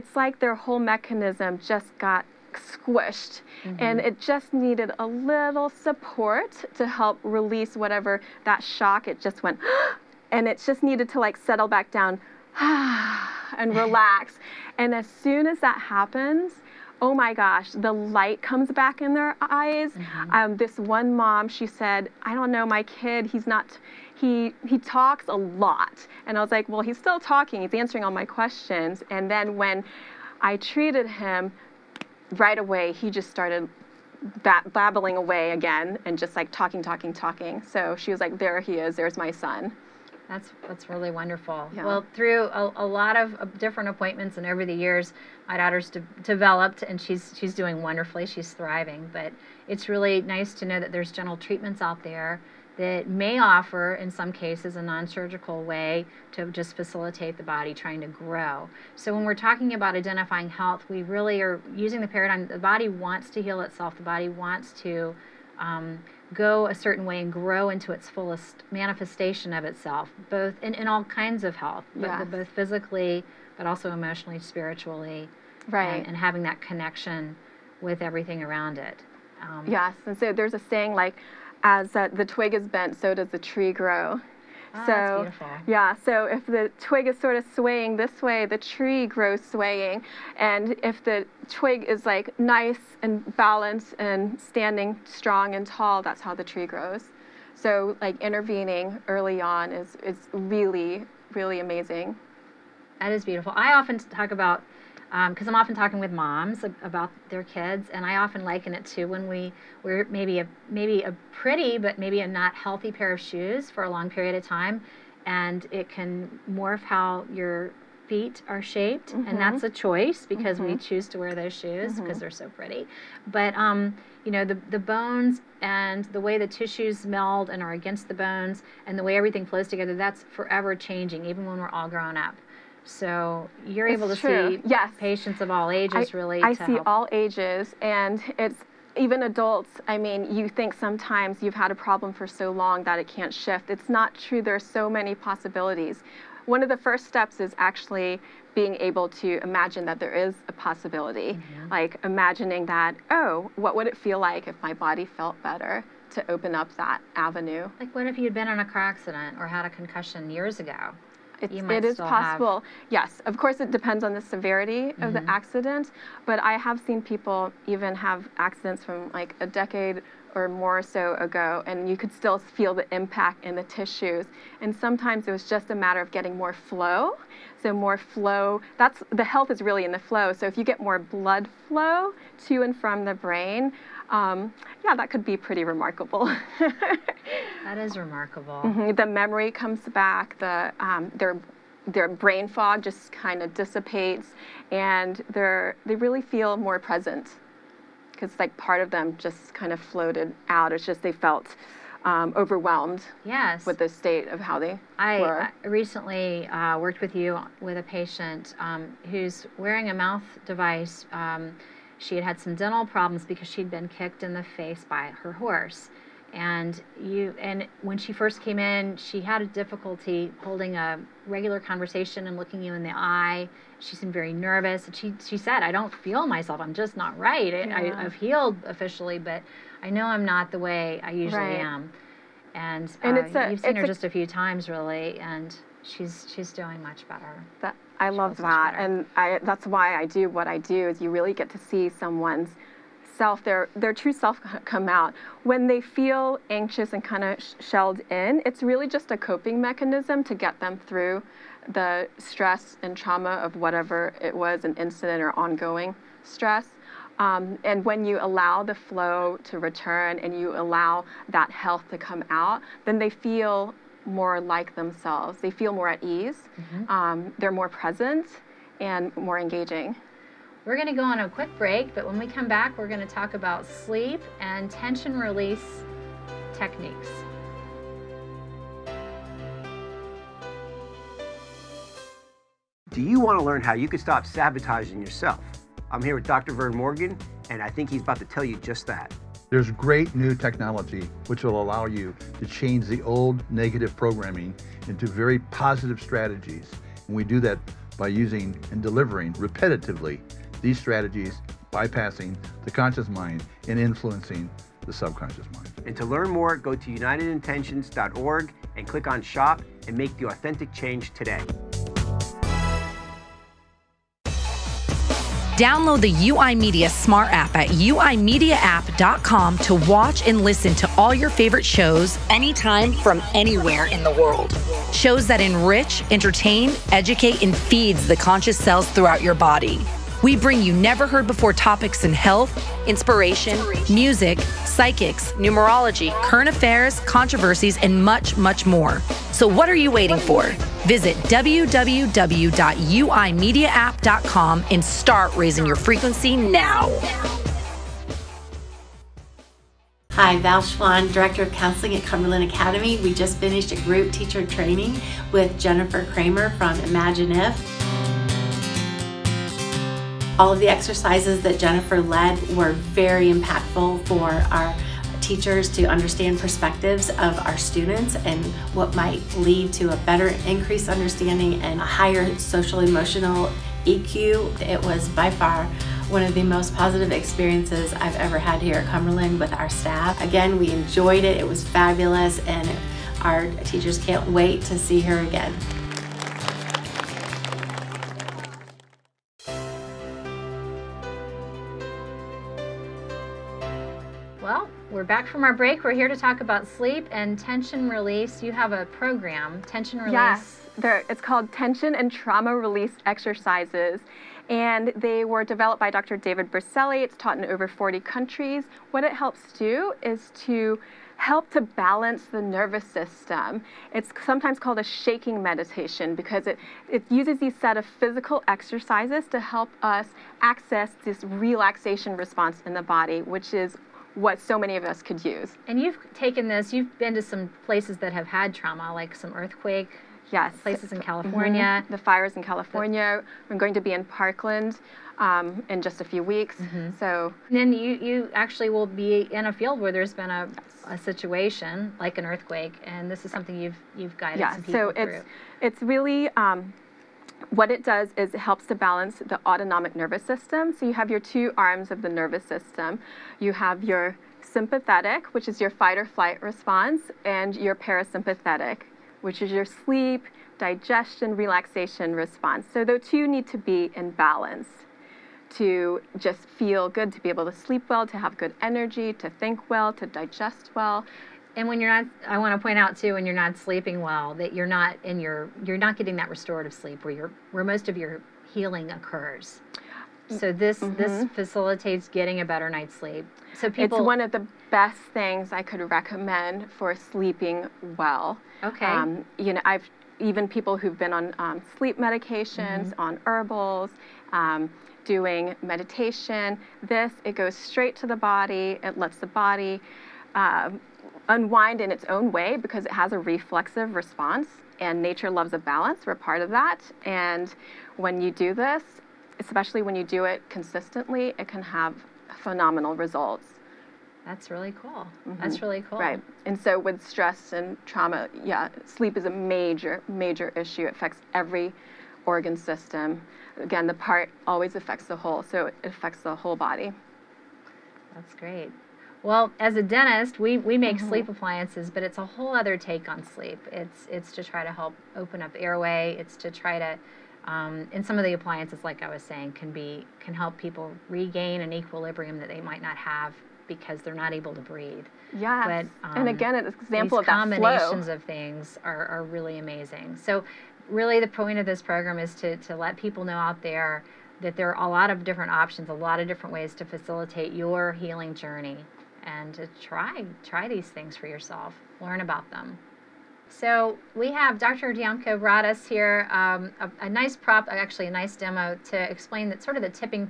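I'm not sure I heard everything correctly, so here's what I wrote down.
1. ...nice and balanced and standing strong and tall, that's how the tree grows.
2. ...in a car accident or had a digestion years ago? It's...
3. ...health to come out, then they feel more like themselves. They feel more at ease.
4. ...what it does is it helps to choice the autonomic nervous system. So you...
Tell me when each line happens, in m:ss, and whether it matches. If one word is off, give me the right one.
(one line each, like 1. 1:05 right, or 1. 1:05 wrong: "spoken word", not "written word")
1. 1:32 right
2. 2:38 wrong: "concussion", not "digestion"
3. 4:21 right
4. 7:27 wrong: "balance", not "choice".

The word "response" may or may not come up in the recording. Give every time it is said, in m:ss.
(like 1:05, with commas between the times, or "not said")
7:02, 7:36, 7:42, 8:23.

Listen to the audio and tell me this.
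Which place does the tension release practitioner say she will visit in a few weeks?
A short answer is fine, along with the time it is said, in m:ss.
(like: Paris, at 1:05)
Parkland, at 7:14.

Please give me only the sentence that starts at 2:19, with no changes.
I mean, you think sometimes you've had a problem for so long that it can't shift.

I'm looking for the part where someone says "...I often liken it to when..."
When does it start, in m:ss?
1:48.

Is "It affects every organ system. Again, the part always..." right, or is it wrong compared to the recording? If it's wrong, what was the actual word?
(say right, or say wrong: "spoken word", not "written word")
right.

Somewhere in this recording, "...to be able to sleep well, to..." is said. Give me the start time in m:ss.
7:47.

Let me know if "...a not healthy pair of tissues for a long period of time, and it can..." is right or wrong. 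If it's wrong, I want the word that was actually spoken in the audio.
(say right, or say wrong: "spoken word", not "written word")
wrong: "shoes", not "tissues".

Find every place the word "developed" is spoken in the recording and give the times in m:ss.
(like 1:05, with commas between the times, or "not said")
0:46, 6:45.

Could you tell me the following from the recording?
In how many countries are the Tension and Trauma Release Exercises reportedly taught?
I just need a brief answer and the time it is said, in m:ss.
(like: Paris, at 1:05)
Over 40, at 6:47.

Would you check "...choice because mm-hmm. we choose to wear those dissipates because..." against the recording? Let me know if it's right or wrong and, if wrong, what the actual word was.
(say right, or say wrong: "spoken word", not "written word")
wrong: "shoes", not "dissipates".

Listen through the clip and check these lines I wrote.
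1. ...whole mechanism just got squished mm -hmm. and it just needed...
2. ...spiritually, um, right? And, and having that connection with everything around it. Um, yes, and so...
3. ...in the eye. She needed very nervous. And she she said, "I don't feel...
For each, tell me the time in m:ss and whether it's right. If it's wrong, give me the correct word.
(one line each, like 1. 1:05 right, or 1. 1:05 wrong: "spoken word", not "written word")
1. 0:00 right
2. 1:14 right
3. 3:42 wrong: "seemed", not "needed".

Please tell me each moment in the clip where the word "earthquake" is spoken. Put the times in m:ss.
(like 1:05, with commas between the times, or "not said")
7:09, 7:22.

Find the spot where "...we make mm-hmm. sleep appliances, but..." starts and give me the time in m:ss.
8:50.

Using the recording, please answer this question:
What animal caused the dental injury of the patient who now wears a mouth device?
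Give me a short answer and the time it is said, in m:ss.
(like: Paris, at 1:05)
Her horse, at 3:35.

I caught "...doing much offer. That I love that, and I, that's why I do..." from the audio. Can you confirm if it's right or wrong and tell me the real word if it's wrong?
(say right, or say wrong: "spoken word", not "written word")
wrong: "better", not "offer".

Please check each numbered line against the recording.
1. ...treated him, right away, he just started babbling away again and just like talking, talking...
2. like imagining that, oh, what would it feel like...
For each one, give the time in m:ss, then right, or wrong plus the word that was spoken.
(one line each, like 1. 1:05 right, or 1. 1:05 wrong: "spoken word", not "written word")
1. 0:30 right
2. 2:31 right.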